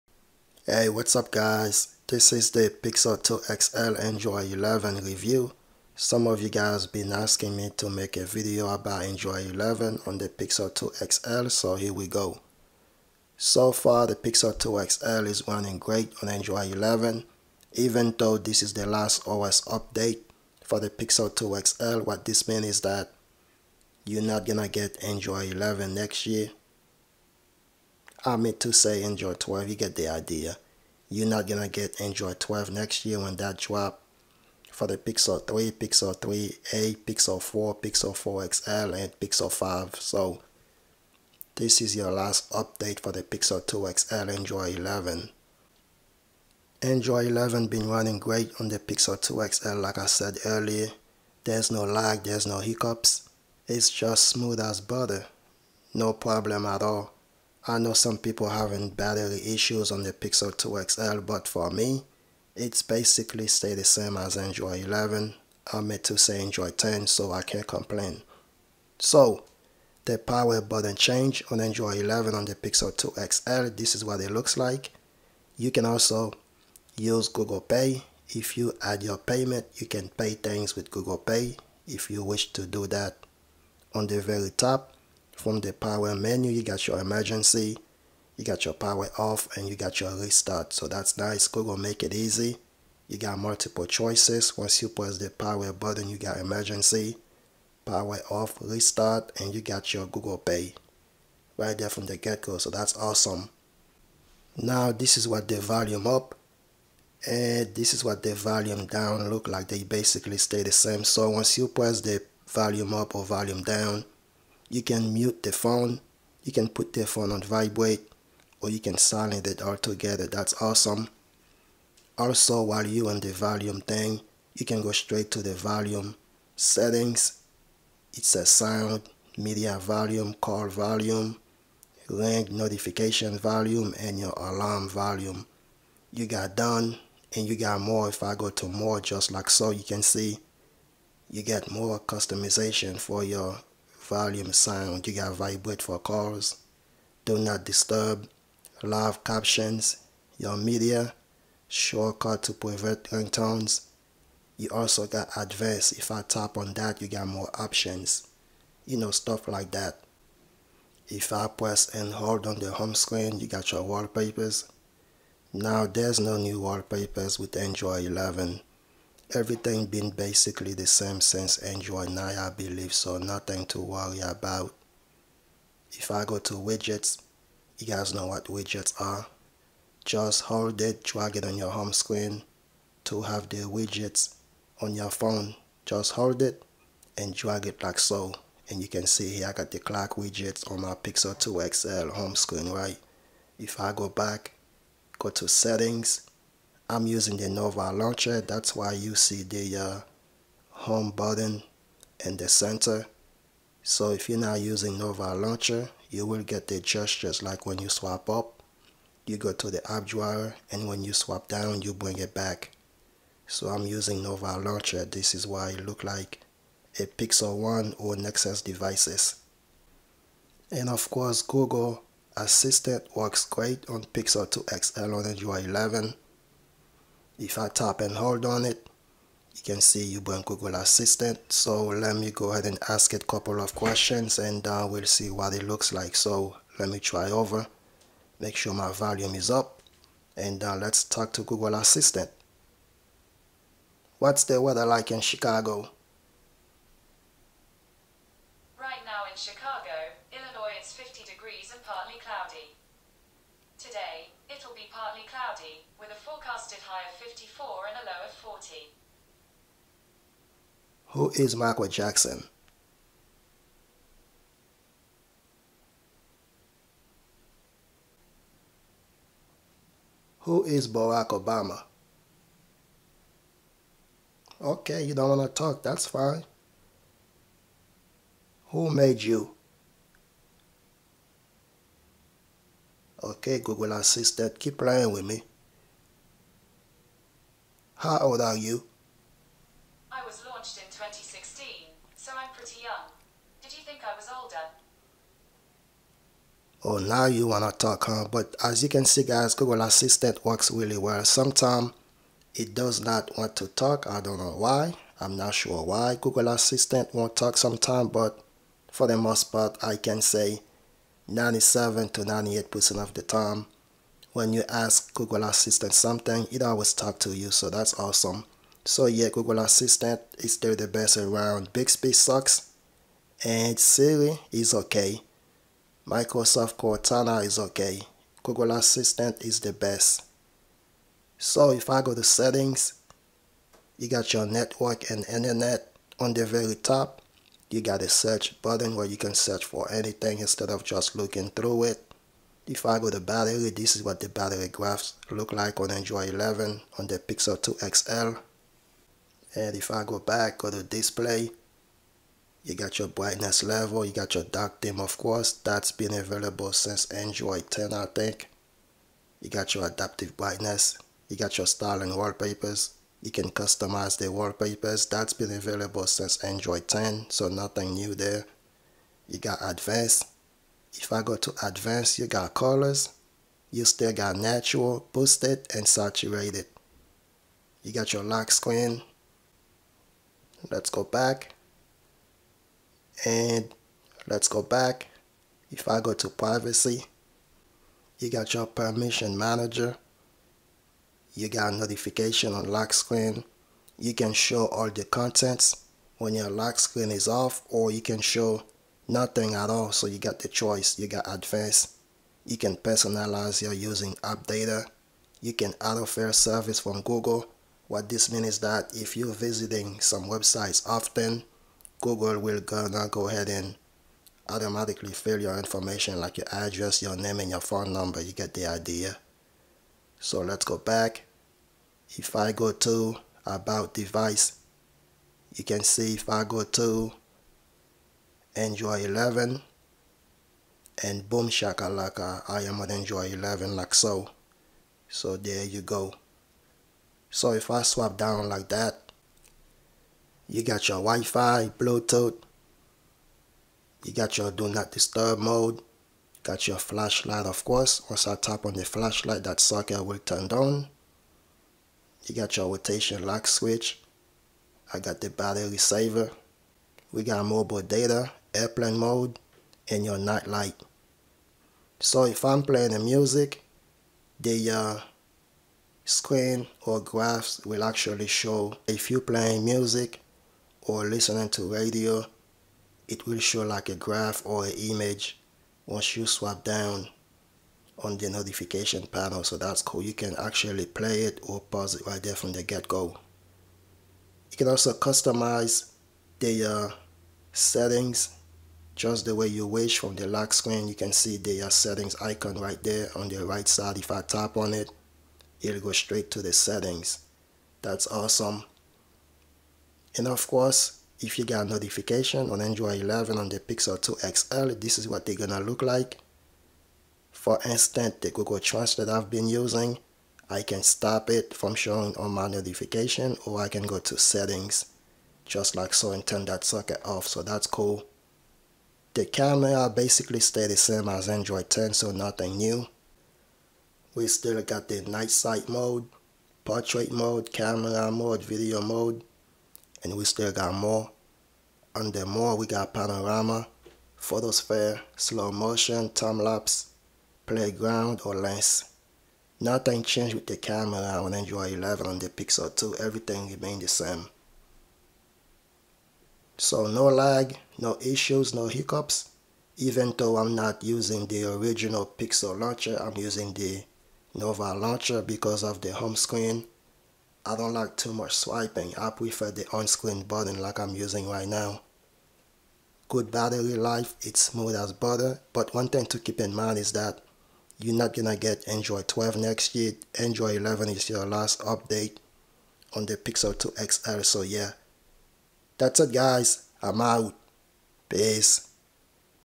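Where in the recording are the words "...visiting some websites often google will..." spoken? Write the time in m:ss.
6:49.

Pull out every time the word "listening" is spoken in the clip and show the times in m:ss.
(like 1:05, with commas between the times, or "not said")
7:51.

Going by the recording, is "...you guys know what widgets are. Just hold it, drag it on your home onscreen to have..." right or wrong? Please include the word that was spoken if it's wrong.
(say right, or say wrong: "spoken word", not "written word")
wrong: "screen", not "onscreen".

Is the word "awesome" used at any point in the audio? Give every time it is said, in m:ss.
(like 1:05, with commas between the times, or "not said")
1:42, 2:00, 5:17, 8:18.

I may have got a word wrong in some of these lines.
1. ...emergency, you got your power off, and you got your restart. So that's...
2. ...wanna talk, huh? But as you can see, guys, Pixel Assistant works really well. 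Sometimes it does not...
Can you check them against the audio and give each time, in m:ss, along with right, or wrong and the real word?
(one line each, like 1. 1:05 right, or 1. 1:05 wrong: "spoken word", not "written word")
1. 1:26 right
2. 4:57 wrong: "Google", not "Pixel".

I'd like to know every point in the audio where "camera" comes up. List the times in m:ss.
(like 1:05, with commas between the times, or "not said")
8:39, 8:47, 9:00.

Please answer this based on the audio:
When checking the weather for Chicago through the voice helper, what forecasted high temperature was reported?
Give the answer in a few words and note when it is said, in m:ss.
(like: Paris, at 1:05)
54, at 4:17.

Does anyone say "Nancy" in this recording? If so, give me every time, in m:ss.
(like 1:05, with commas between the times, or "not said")
not said.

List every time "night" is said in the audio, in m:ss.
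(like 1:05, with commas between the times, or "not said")
7:40, 8:45.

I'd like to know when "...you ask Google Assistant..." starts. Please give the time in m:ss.
5:14.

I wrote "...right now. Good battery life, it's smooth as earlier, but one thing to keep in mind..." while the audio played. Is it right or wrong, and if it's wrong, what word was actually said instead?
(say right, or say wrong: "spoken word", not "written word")
wrong: "butter", not "earlier".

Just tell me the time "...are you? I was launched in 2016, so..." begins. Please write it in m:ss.
4:48.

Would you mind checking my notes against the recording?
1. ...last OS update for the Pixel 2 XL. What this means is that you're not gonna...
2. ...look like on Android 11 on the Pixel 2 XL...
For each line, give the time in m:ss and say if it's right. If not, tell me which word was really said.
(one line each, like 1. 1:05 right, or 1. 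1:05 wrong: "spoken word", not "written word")
1. 0:18 right
2. 5:45 right.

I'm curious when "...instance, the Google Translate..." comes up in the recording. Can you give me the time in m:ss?
8:27.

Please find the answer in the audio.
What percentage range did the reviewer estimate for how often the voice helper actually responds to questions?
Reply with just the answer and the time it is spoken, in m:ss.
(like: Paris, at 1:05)
97 to 98%, at 5:11.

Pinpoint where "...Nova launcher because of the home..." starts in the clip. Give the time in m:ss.
9:14.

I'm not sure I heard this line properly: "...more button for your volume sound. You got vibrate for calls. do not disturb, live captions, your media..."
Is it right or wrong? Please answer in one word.
wrong.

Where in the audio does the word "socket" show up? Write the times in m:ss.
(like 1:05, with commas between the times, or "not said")
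7:29, 8:36.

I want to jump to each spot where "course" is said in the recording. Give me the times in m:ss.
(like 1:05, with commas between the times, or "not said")
3:41, 5:55, 7:27, 8:20.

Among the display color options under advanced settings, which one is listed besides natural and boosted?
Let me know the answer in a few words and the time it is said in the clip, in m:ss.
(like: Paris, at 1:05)
saturated, at 6:15.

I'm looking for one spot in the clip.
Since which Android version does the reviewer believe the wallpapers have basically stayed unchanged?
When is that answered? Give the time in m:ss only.
2:51.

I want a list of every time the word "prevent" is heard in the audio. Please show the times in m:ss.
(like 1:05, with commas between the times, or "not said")
2:32.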